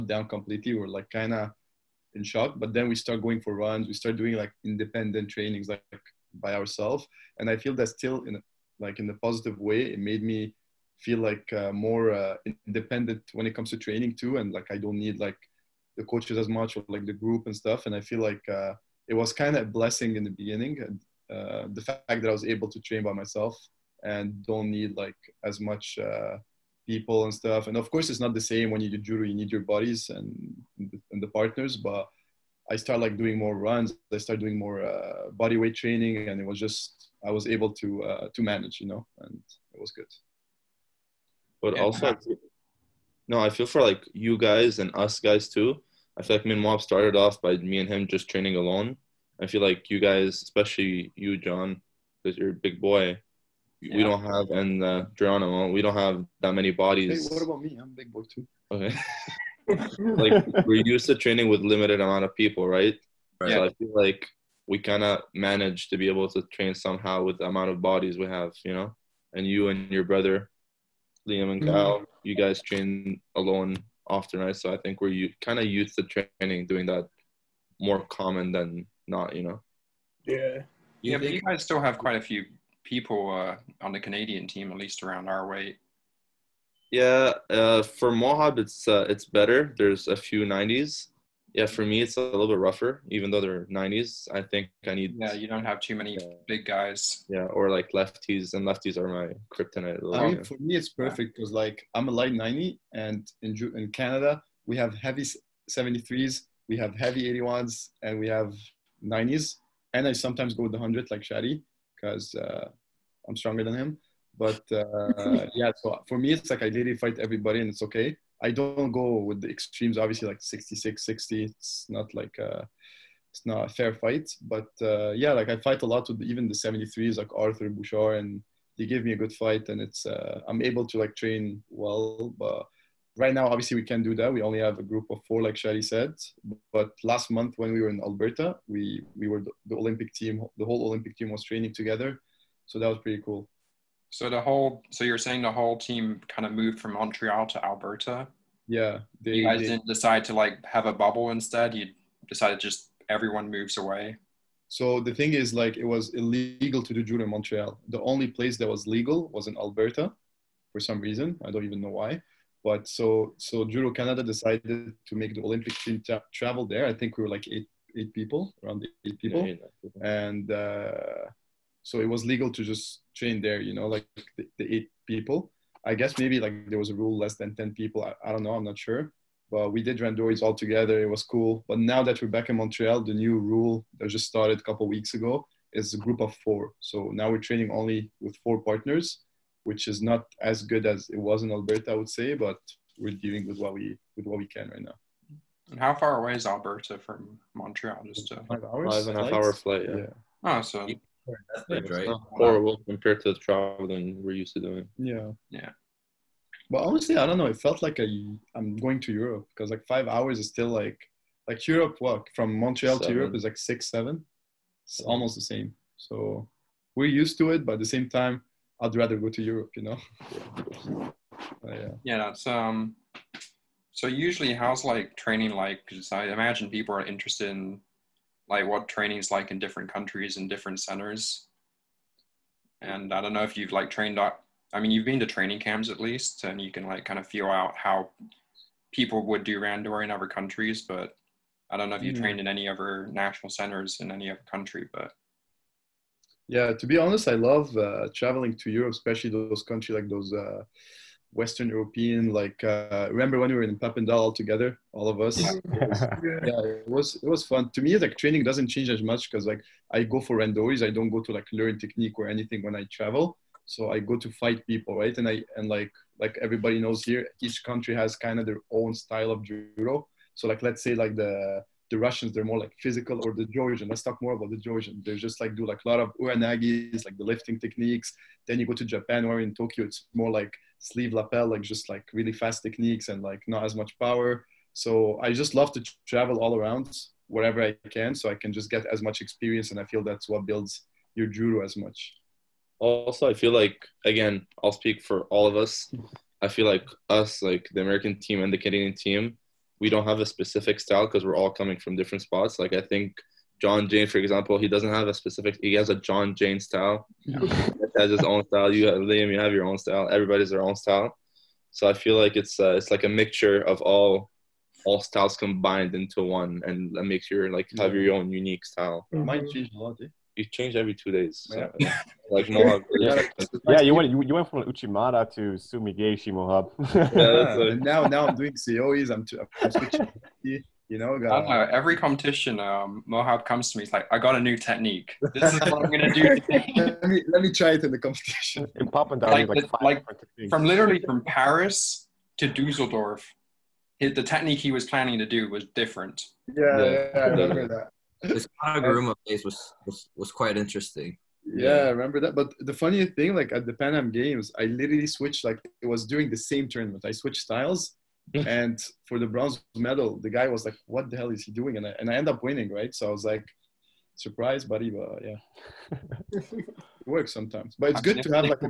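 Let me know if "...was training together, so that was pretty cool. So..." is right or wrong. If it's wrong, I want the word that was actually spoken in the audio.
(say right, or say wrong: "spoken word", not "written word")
right.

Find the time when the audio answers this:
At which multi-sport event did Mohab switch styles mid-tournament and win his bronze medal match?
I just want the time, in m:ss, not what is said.
5:53.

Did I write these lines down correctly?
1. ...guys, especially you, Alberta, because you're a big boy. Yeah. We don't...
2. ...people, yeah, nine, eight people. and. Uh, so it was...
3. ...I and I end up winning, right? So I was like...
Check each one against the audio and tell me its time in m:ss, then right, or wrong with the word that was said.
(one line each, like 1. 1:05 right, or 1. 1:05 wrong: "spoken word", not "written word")
1. 0:49 wrong: "John", not "Alberta"
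2. 2:49 wrong: "eight", not "nine"
3. 6:01 right.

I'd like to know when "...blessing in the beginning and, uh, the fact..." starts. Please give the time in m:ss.
0:19.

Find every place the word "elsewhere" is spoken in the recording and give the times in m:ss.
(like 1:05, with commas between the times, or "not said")
not said.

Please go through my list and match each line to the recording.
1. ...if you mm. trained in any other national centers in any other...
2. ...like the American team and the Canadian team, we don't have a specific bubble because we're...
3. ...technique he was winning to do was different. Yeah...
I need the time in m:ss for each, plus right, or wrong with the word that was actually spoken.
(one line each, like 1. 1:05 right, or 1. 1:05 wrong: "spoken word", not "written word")
1. 4:01 right
2. 4:57 wrong: "style", not "bubble"
3. 5:44 wrong: "planning", not "winning".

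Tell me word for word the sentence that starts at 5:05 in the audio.
He has a John Jayne style.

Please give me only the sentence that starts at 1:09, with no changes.
And you and your brother Liam and Kyle, mm-hmm.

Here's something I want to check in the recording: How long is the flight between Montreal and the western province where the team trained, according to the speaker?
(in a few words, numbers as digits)
5.5 hours.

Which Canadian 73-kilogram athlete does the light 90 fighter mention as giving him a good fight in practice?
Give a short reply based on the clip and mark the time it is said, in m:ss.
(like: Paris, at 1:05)
Arthur Bouchard, at 2:07.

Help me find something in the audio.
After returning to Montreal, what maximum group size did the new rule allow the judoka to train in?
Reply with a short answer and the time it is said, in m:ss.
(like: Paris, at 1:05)
4, at 3:05.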